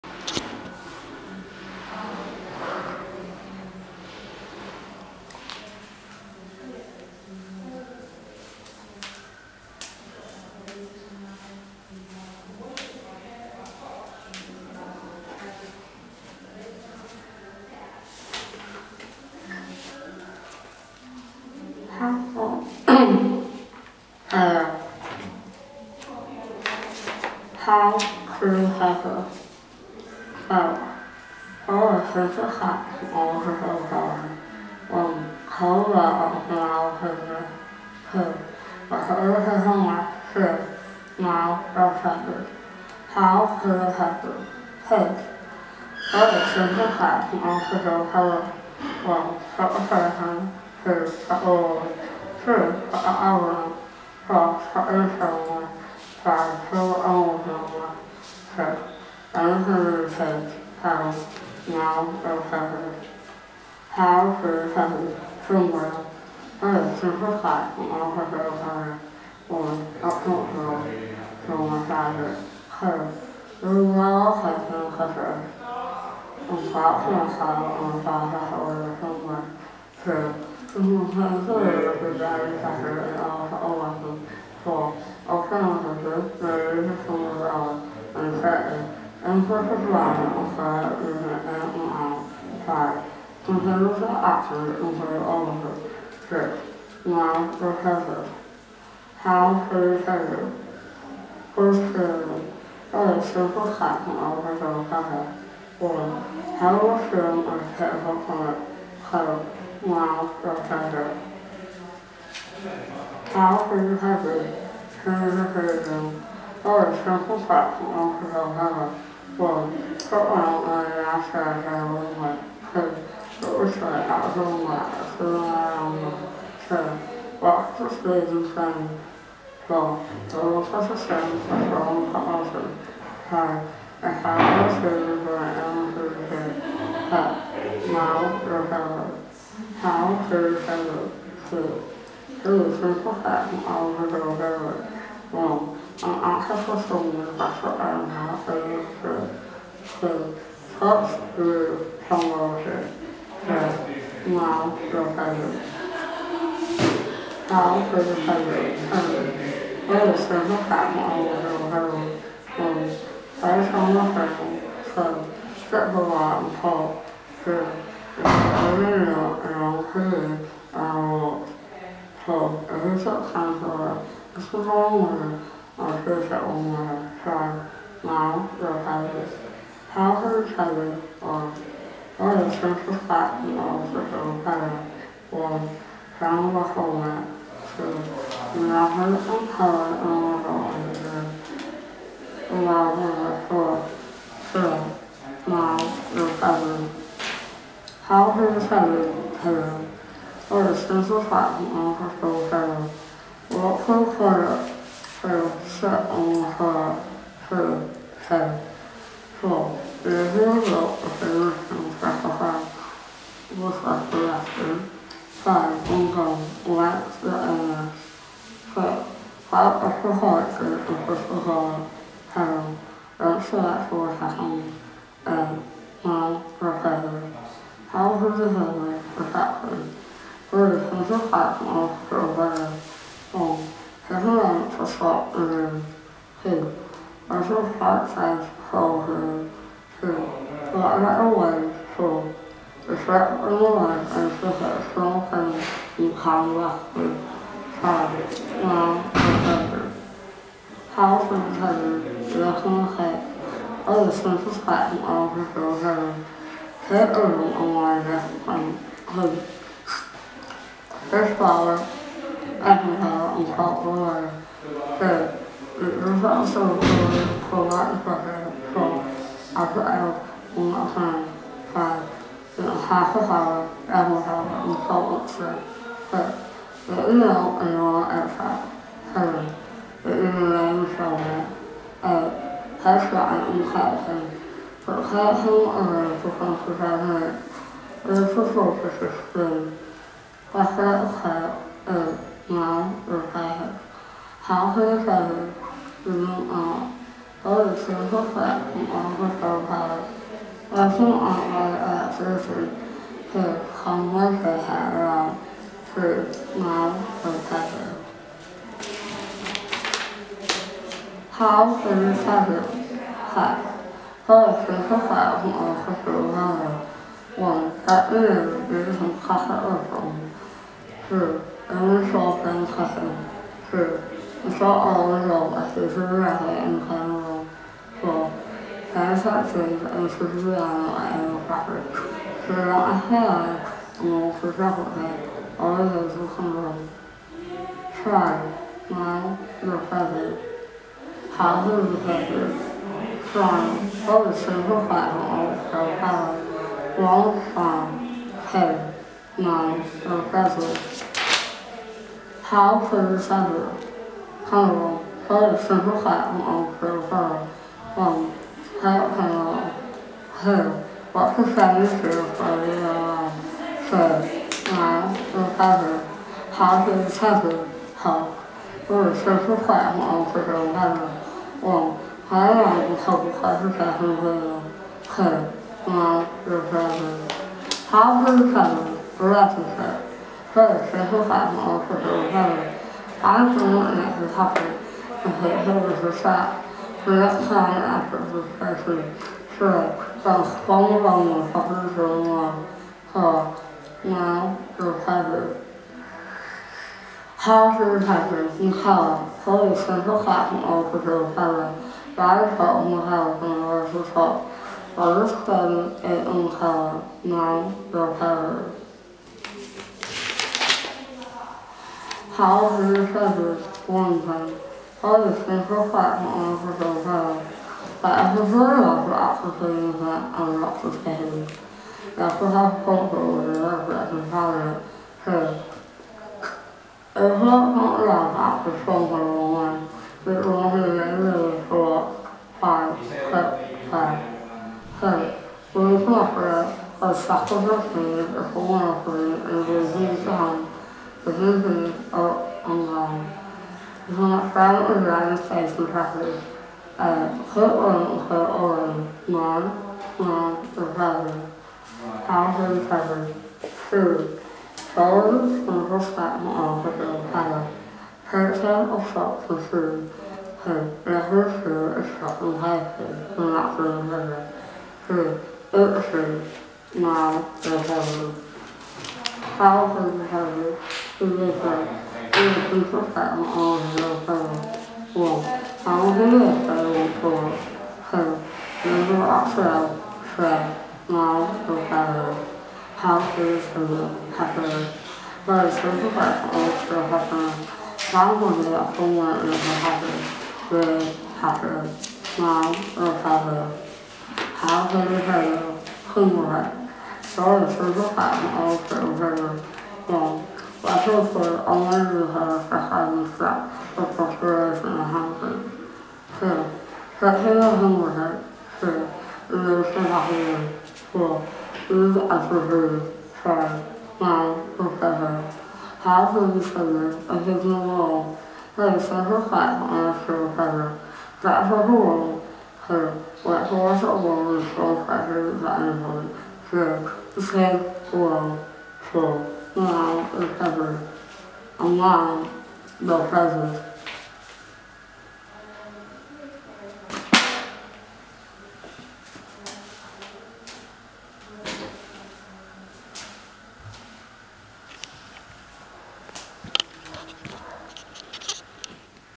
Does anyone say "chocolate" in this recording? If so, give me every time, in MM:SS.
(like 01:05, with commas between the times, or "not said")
05:34.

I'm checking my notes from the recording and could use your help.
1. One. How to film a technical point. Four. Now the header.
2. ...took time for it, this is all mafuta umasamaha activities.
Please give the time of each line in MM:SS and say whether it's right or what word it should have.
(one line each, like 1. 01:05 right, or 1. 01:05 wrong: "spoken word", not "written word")
1. 01:45 wrong: "Two", not "Four"
2. 02:53 wrong: "locales", not "activities".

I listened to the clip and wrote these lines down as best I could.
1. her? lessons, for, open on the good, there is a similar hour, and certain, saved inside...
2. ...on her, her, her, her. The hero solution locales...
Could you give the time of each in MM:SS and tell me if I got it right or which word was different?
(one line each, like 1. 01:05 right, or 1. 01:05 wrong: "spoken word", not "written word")
1. 01:23 wrong: "incorporated", not "saved"
2. 03:26 wrong: "specifies", not "locales".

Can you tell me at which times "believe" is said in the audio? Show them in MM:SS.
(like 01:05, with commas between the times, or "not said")
06:23.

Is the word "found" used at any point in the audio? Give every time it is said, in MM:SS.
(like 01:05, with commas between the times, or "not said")
03:06.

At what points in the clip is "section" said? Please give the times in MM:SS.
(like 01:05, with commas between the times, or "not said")
01:43, 01:57.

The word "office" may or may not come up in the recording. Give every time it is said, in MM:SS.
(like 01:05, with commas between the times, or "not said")
03:03, 03:21.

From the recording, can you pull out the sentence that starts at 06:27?
The next time after his session, sure, that's one wrong with fucking going on.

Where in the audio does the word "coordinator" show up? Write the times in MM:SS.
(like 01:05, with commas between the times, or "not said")
not said.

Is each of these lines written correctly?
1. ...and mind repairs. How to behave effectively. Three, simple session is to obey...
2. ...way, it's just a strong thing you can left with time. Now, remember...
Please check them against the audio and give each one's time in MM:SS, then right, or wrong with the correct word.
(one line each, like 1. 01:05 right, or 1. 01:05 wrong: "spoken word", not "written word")
1. 03:45 wrong: "action", not "session"
2. 04:03 right.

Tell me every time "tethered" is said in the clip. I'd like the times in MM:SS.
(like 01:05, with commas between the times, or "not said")
06:35, 06:48.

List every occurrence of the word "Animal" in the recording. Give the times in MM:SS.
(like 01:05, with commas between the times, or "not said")
05:31.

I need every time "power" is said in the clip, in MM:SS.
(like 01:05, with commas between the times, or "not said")
05:45.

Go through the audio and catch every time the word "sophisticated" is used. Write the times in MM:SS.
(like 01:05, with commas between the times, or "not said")
03:40.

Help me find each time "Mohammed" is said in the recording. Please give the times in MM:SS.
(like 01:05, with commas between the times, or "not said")
03:08.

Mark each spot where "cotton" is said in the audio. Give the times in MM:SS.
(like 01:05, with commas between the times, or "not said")
03:03, 03:21.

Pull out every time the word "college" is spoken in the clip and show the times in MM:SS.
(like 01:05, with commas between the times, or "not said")
06:38, 06:46.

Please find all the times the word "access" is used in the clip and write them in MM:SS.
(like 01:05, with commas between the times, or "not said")
02:26.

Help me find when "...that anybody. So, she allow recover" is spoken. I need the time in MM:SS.
08:45.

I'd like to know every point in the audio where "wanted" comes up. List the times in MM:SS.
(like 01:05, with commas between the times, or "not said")
04:17, 08:21.